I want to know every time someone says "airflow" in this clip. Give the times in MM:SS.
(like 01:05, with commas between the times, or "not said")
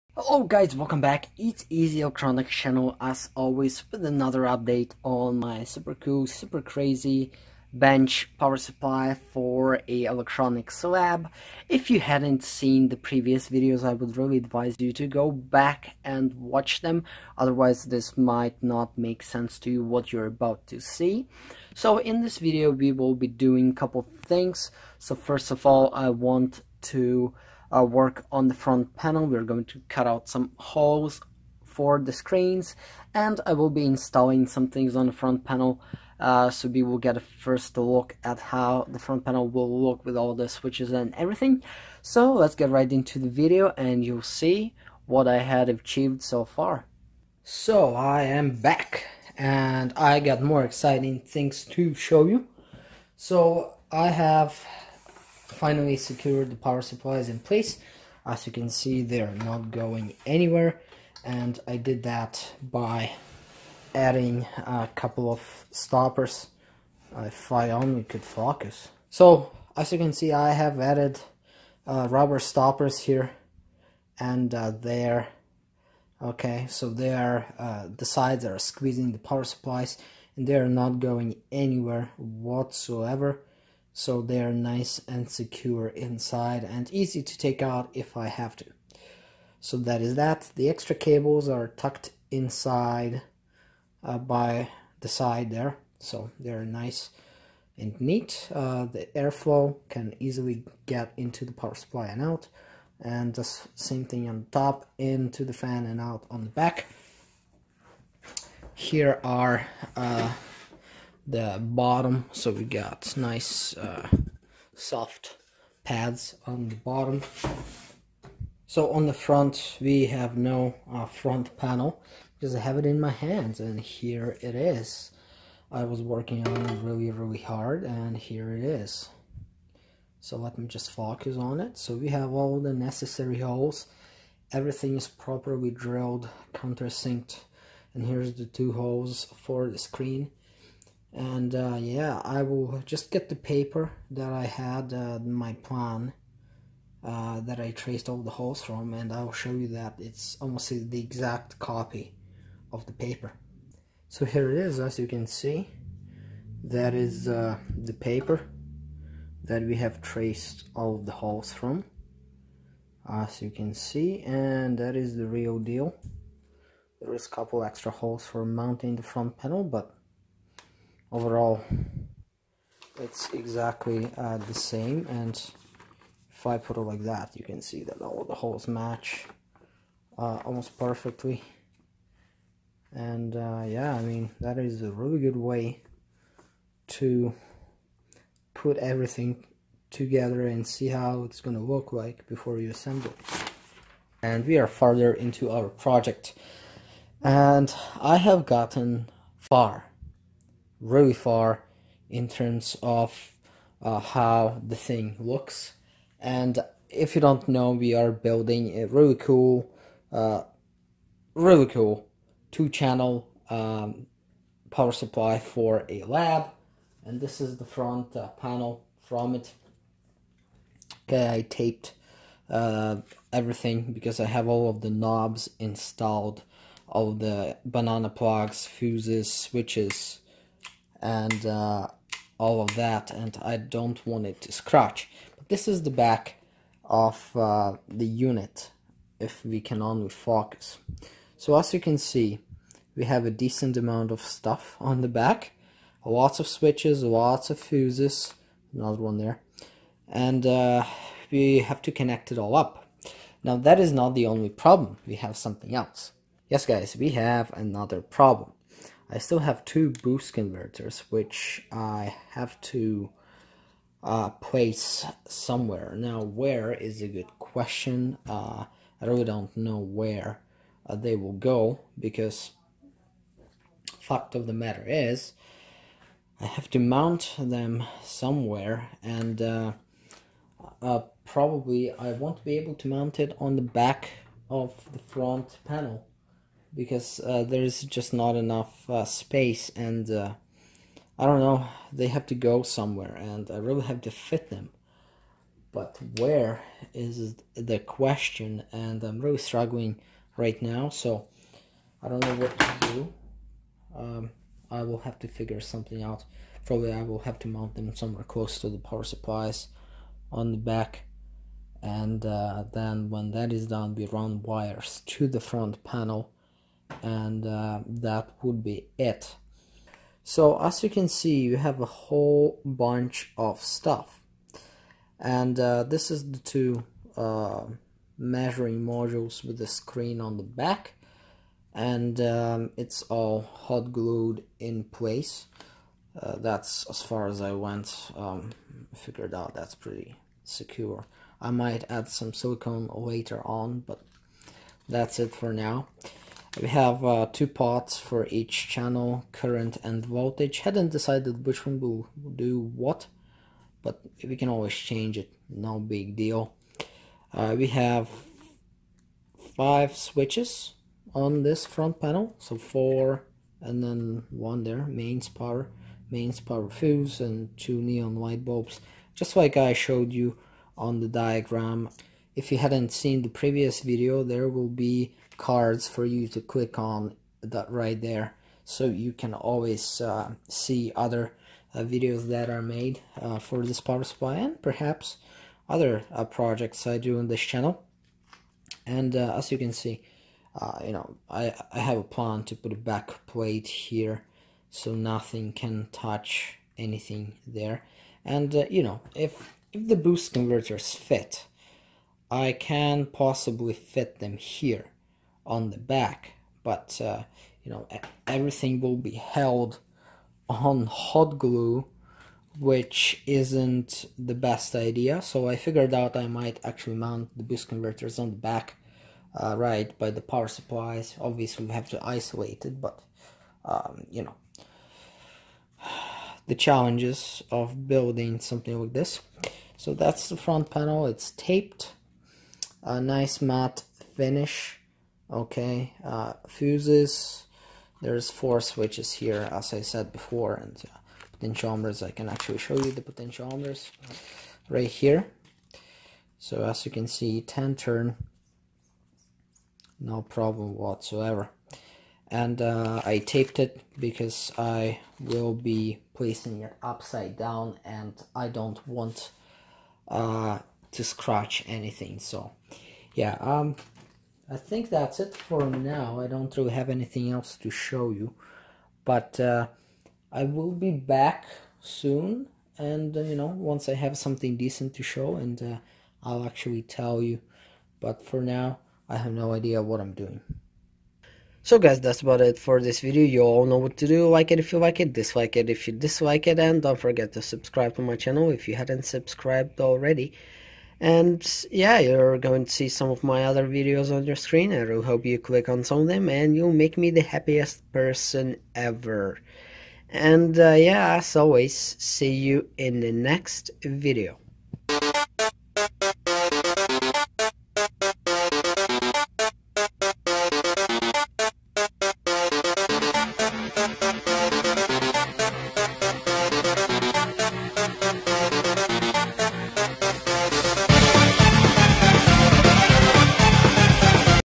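01:39.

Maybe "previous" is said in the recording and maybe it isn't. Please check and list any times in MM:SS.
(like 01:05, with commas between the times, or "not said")
00:12, 06:13.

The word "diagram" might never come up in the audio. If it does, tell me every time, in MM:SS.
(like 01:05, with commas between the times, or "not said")
06:11.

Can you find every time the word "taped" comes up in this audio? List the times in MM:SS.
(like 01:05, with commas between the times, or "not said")
03:41, 07:11, 07:33.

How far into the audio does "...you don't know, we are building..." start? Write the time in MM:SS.
03:27.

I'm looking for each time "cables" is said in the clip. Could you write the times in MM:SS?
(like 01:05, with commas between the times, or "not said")
01:30.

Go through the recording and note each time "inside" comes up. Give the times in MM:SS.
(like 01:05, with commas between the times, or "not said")
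01:25, 01:32.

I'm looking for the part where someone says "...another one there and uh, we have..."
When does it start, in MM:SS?
04:08.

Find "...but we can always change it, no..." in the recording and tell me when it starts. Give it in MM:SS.
05:53.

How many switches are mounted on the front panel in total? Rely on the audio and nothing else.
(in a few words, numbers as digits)
5.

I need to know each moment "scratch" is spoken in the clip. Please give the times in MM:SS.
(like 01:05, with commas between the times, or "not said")
03:54, 07:41.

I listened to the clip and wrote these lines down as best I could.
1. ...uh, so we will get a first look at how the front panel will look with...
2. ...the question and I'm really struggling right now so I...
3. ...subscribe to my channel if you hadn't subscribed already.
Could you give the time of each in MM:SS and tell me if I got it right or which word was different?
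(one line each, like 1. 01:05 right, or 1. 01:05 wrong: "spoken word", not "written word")
1. 00:36 right
2. 04:57 right
3. 08:07 right.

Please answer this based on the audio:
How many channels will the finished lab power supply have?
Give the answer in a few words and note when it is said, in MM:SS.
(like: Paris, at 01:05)
2, at 03:32.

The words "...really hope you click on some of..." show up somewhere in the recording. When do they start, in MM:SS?
08:14.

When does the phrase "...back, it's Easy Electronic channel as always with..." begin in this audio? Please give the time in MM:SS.
00:01.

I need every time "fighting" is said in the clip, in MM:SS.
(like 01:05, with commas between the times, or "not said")
not said.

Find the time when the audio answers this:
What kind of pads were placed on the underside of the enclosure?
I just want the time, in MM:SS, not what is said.
01:54.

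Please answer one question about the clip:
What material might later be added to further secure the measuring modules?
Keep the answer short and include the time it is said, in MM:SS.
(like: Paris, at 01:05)
Silicone, at 05:42.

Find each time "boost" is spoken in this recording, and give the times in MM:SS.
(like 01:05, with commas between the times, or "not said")
04:20, 06:39, 06:57.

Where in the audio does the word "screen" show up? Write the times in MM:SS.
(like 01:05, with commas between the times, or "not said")
00:32, 02:19, 05:29, 08:14.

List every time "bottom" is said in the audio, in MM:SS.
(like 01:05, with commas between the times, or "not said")
01:51, 01:56.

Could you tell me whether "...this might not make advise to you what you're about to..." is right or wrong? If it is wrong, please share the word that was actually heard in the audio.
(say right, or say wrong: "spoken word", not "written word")
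wrong: "sense", not "advise".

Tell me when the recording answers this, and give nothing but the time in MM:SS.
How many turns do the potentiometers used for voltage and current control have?
07:27.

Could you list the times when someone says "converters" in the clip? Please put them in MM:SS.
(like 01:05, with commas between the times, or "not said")
04:20, 06:40, 06:57.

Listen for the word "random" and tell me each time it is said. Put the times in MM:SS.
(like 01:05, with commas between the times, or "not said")
not said.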